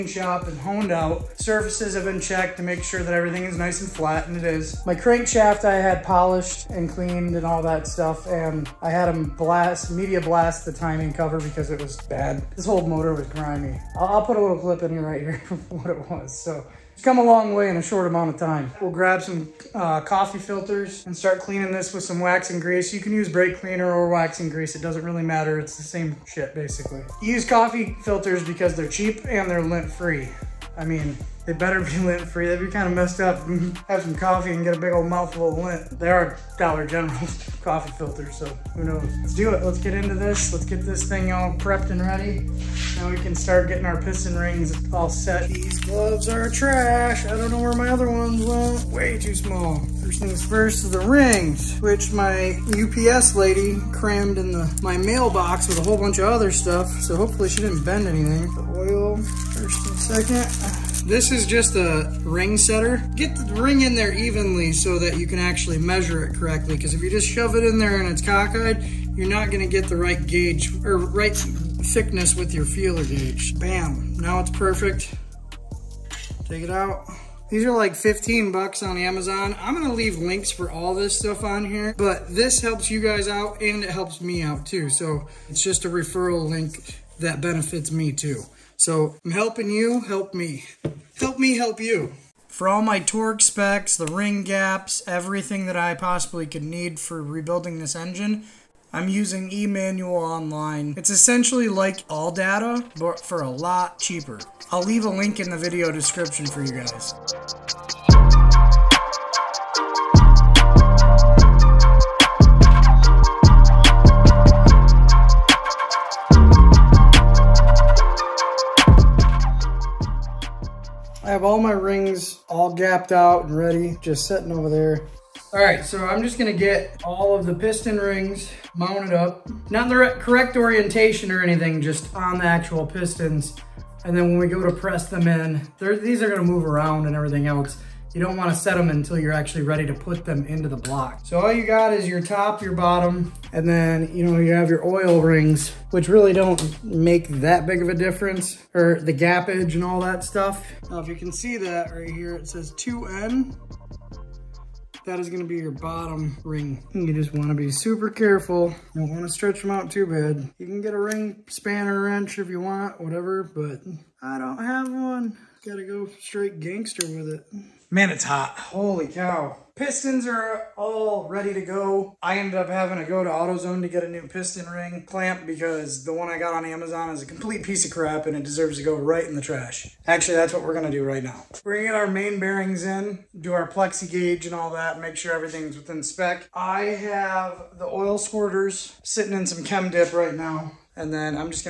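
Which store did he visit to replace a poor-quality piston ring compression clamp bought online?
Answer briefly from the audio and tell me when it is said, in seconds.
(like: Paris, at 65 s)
AutoZone, at 173 s.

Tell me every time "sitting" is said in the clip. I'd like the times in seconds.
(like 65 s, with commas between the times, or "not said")
124 s, 189 s.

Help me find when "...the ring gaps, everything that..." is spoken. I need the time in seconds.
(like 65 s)
93 s.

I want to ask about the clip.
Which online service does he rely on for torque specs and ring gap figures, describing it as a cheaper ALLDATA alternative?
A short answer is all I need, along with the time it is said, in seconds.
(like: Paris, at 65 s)
eManual Online, at 99 s.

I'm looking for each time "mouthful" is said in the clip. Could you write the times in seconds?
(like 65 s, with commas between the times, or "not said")
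35 s.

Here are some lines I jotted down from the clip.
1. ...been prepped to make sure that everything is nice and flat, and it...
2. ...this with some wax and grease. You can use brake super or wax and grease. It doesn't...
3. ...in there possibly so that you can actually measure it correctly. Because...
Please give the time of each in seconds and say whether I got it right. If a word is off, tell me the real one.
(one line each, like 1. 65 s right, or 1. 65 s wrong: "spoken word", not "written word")
1. 2 s wrong: "checked", not "prepped"
2. 21 s wrong: "cleaner", not "super"
3. 63 s wrong: "evenly", not "possibly".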